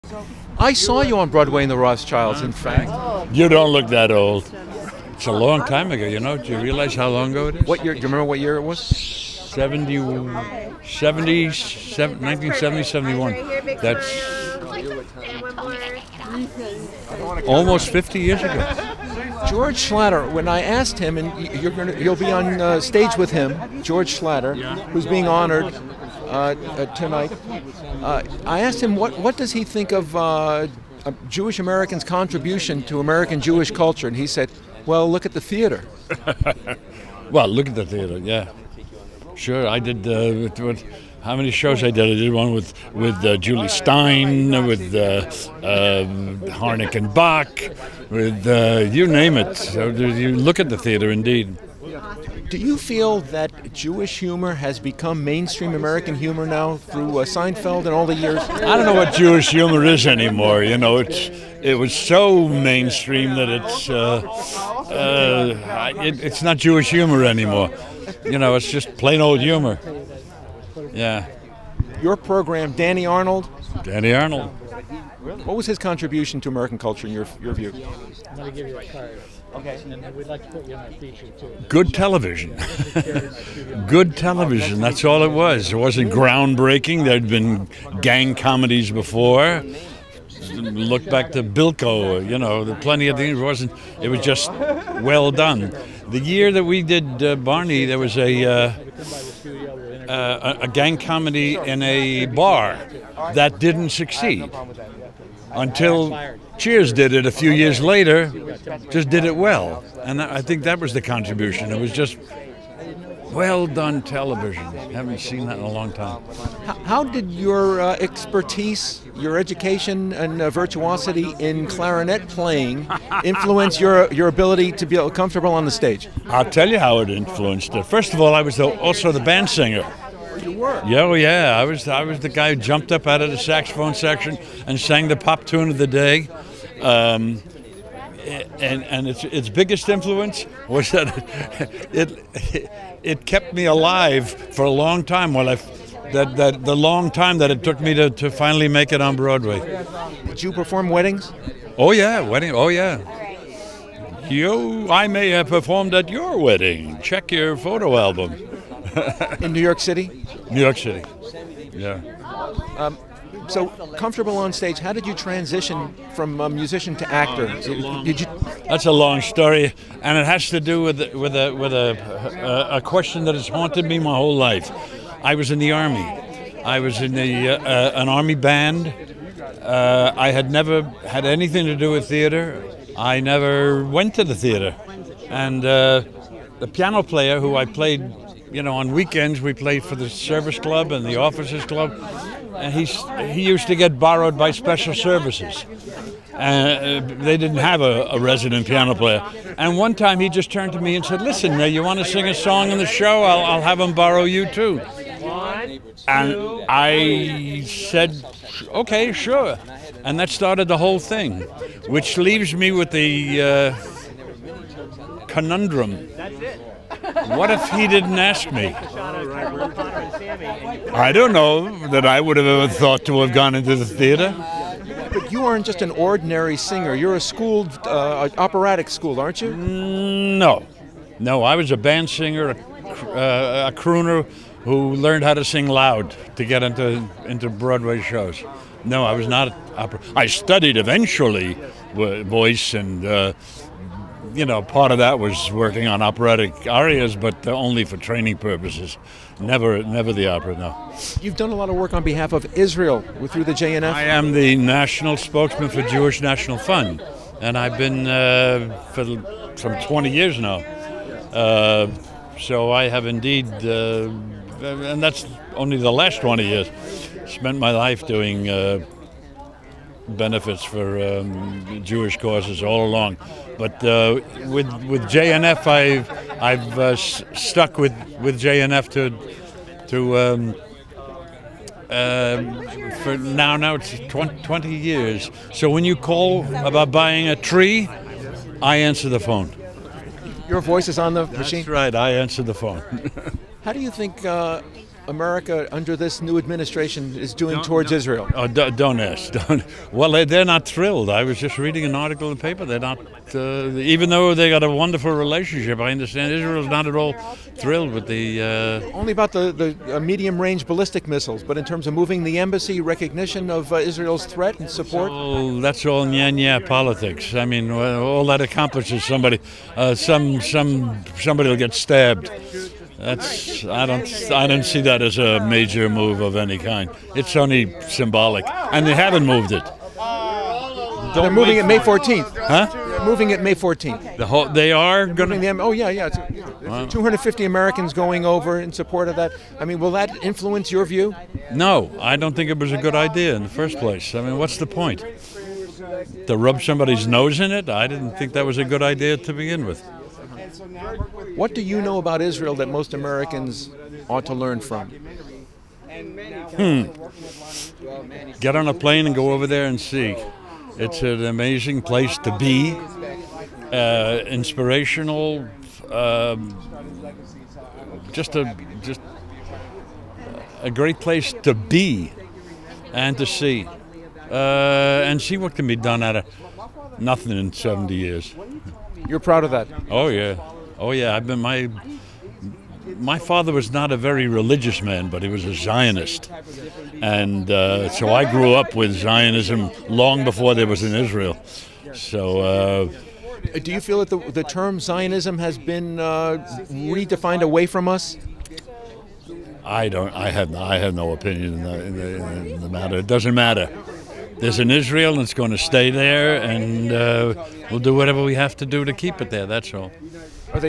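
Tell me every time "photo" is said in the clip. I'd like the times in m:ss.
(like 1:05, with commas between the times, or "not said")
2:37.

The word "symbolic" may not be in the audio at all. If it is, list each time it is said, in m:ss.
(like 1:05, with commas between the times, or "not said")
5:27.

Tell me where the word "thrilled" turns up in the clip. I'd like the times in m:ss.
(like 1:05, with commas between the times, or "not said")
5:00, 5:07.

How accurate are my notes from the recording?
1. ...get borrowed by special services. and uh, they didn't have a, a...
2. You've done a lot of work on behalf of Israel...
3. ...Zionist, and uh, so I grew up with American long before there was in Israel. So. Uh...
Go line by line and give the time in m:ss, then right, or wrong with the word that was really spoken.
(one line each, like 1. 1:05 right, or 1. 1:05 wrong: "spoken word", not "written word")
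1. 3:13 right
2. 4:11 right
3. 6:25 wrong: "Zionism", not "American".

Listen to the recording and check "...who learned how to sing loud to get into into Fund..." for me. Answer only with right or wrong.
wrong.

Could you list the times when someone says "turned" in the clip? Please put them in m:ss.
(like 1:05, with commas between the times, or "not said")
3:20.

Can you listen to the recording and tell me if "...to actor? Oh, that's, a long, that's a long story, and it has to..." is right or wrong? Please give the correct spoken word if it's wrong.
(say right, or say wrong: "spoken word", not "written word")
right.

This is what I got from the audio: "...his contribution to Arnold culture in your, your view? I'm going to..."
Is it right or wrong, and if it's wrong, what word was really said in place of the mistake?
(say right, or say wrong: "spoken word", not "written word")
wrong: "American", not "Arnold".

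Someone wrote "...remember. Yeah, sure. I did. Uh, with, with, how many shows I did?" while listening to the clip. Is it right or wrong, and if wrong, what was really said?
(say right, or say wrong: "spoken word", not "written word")
wrong: "theater", not "remember".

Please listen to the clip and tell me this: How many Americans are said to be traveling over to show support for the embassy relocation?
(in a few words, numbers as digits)
250.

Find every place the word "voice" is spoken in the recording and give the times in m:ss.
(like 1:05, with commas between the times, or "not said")
4:02, 4:50.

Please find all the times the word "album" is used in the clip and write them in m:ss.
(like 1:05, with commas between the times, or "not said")
2:37.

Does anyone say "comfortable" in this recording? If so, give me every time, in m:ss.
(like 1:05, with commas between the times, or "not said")
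2:05, 2:43.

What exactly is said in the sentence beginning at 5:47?
I didn't think that was a good idea to begin with.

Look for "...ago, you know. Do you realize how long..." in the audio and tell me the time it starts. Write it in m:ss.
0:05.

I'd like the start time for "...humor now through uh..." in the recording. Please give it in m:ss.
0:56.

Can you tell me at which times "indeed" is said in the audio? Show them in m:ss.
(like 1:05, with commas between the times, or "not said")
0:51, 4:23.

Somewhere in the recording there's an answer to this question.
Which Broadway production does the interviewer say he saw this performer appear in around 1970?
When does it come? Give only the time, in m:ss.
0:01.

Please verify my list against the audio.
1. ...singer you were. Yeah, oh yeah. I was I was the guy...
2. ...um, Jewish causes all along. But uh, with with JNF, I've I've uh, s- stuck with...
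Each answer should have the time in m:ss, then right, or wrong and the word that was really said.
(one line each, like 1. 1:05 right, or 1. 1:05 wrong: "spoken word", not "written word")
1. 2:09 right
2. 4:31 right.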